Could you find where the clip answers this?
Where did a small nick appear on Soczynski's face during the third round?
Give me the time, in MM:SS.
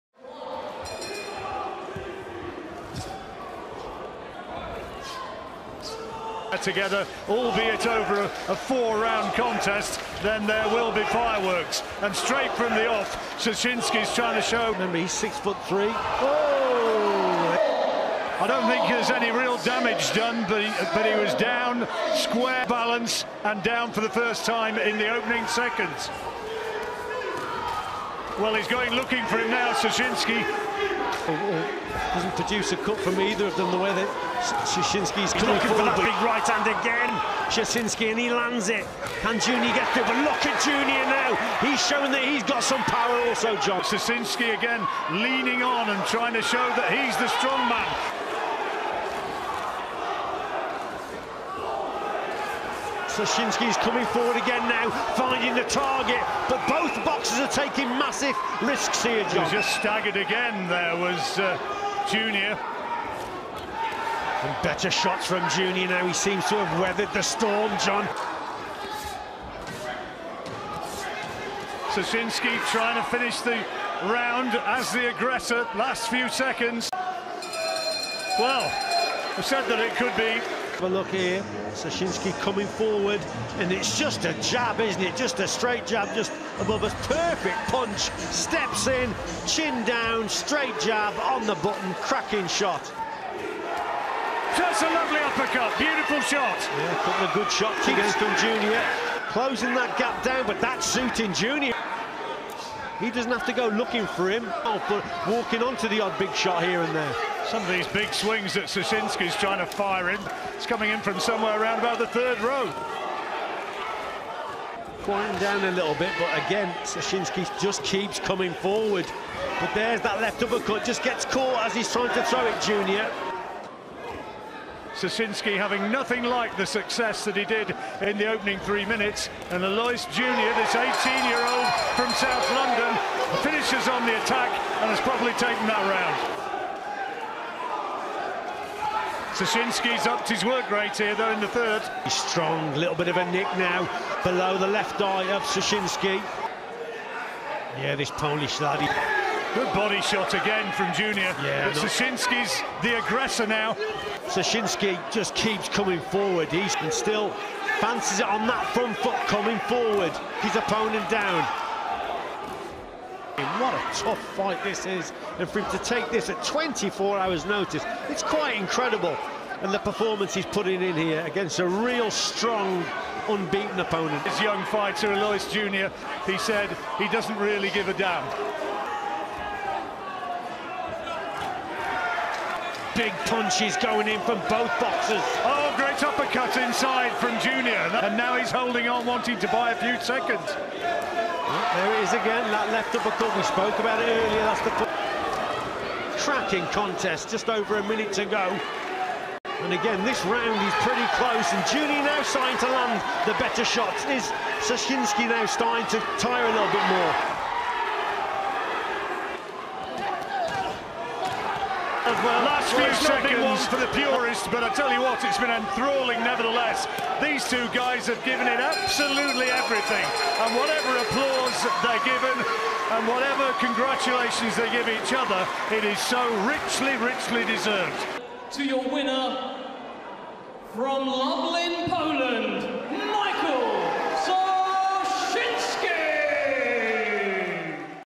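02:24.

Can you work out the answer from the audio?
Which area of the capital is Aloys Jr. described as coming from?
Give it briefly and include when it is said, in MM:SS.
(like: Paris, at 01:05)
South London, at 02:12.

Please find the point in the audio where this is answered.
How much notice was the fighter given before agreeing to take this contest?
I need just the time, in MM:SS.
02:46.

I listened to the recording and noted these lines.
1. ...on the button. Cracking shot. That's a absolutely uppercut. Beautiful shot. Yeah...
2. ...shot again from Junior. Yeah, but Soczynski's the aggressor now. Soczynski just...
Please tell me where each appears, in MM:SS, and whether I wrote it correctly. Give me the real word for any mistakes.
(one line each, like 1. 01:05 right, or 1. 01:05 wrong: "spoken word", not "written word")
1. 01:31 wrong: "lovely", not "absolutely"
2. 02:30 right.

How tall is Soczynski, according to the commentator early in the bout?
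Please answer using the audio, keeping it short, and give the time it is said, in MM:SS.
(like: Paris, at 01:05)
6 foot 3, at 00:15.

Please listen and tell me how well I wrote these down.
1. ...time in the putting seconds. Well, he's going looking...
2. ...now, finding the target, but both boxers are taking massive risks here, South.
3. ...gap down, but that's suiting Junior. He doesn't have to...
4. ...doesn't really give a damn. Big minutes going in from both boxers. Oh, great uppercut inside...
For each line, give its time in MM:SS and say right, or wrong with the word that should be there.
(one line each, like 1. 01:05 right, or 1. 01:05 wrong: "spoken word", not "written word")
1. 00:24 wrong: "opening", not "putting"
2. 00:54 wrong: "John", not "South"
3. 01:39 right
4. 02:57 wrong: "punches", not "minutes".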